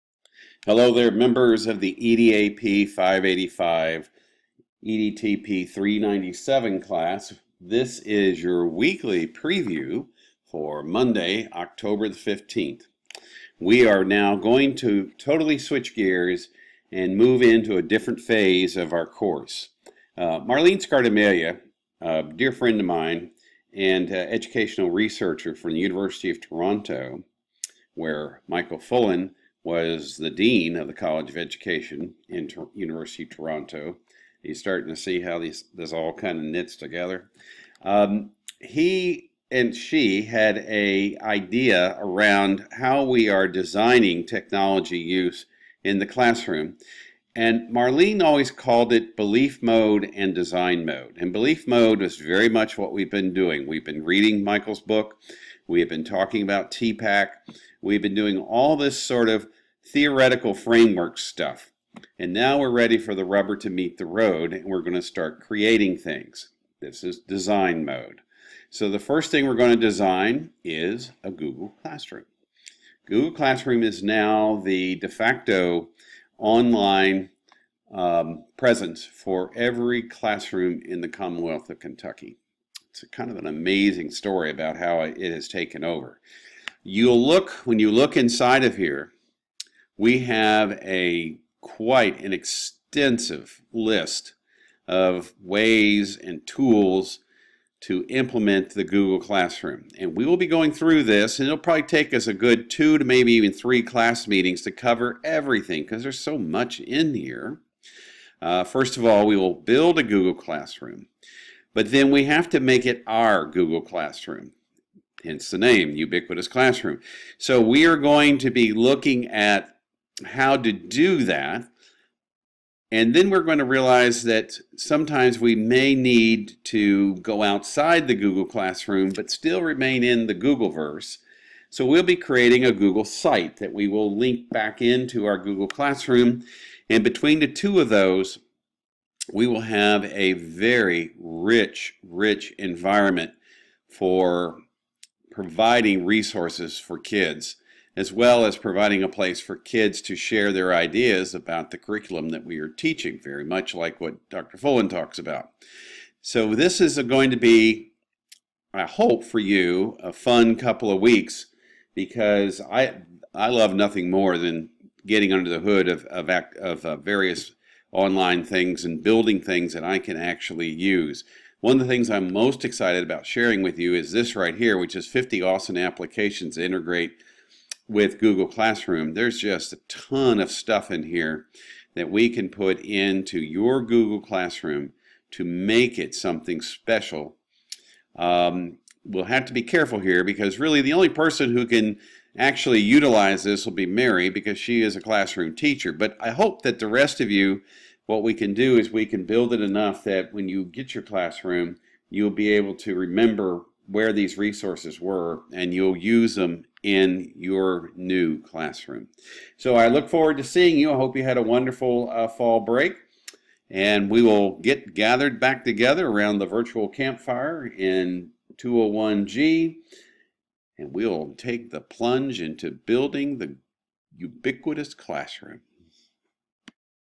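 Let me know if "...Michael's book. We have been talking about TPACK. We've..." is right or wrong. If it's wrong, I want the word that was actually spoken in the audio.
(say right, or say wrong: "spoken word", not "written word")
right.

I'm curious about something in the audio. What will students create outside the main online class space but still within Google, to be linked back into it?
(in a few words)
Google site.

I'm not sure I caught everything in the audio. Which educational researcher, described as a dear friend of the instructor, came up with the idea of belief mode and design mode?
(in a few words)
Marlene Scardamalia.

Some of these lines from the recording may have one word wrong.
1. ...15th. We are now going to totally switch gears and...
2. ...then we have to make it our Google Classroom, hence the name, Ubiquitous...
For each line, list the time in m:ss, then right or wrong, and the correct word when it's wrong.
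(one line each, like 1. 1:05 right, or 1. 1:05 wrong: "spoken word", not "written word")
1. 0:12 right
2. 1:51 right.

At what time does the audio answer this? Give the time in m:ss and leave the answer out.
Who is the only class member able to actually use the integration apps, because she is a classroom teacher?
3:13.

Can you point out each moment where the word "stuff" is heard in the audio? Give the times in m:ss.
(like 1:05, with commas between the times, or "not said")
1:01, 3:00.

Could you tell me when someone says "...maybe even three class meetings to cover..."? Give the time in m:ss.
1:43.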